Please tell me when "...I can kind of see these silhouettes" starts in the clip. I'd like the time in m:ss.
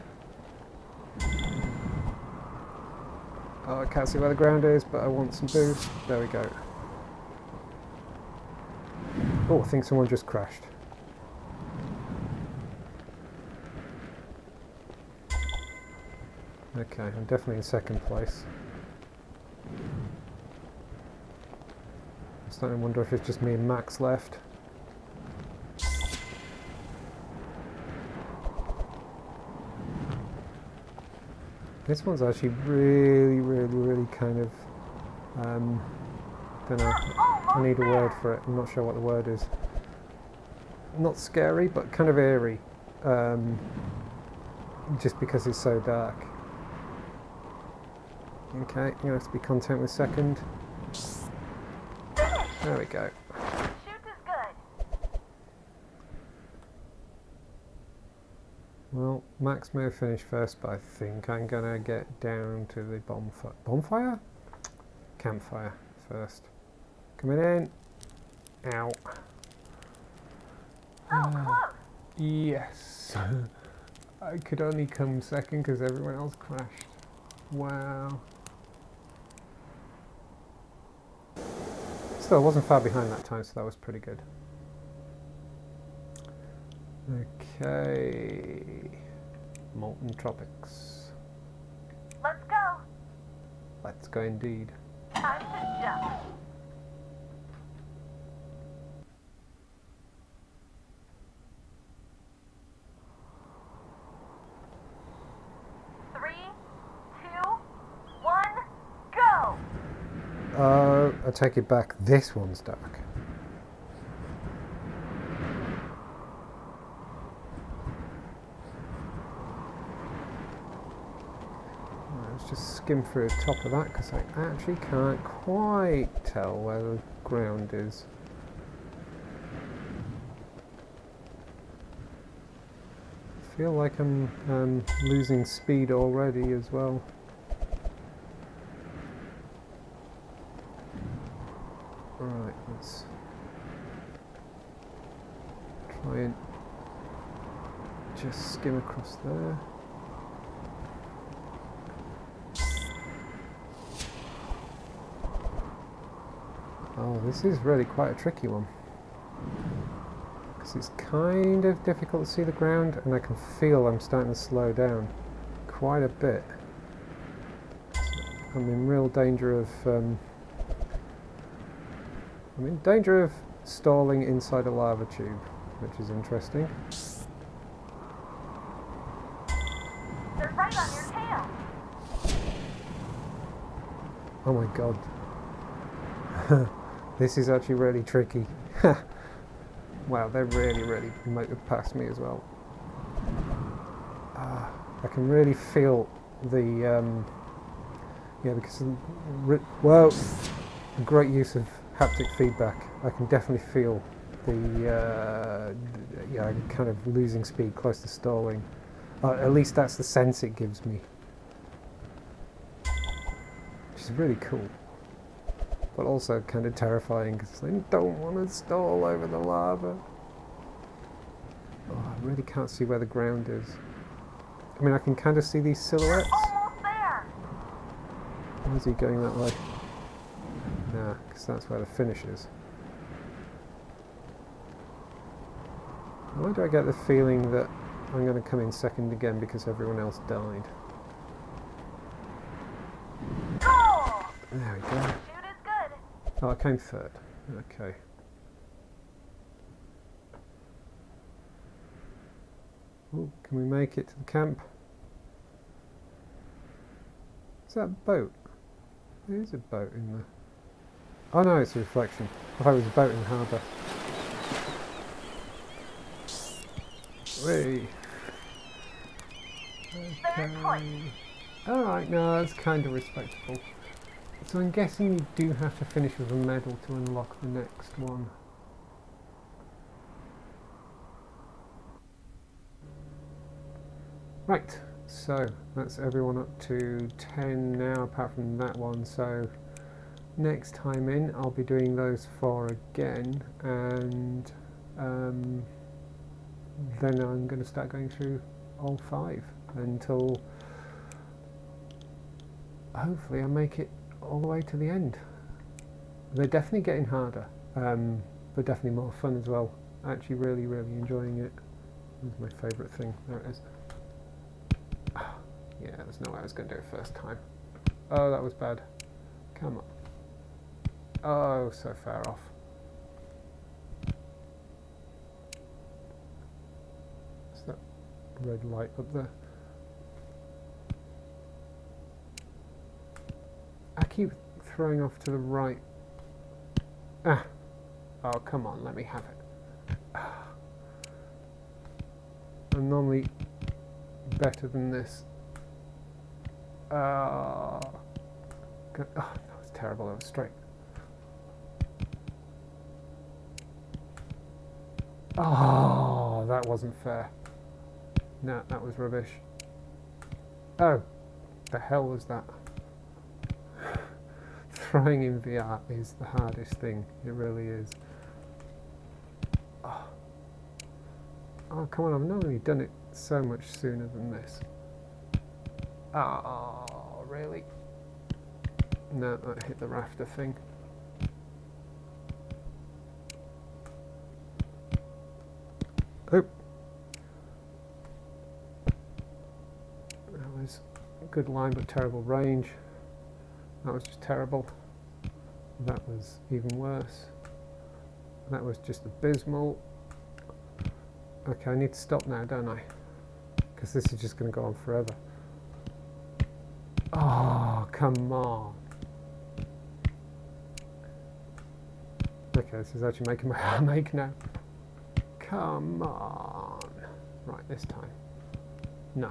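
3:44.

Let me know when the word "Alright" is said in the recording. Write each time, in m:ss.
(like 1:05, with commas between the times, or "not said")
4:31.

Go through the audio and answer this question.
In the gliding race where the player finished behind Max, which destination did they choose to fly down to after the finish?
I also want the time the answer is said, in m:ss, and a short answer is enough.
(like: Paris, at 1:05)
Campfire, at 1:05.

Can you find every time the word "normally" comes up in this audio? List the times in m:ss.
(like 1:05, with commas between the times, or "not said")
5:42, 6:12.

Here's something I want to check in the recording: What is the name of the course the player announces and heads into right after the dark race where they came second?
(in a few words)
Molten Tropics.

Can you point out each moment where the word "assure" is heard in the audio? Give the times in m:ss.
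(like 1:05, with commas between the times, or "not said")
not said.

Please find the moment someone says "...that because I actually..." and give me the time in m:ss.
2:03.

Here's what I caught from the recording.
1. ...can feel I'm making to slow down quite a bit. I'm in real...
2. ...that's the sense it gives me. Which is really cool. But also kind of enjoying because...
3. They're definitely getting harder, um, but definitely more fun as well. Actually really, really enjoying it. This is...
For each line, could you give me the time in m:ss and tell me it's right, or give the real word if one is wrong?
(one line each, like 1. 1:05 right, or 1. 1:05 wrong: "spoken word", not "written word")
1. 2:43 wrong: "starting", not "making"
2. 3:29 wrong: "terrifying", not "enjoying"
3. 5:06 right.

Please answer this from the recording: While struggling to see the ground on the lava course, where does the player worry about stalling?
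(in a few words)
Inside a lava tube.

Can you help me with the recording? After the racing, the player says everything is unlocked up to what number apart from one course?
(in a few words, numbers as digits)
10.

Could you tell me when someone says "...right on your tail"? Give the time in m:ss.
3:00.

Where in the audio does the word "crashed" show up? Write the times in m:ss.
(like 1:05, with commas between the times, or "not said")
0:10, 1:16.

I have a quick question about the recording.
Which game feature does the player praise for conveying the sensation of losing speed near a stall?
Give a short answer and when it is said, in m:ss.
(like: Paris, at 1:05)
Haptic feedback, at 3:21.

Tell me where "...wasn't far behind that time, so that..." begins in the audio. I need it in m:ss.
1:22.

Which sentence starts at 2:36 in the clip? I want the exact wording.
Oh, this is really quite a tricky one.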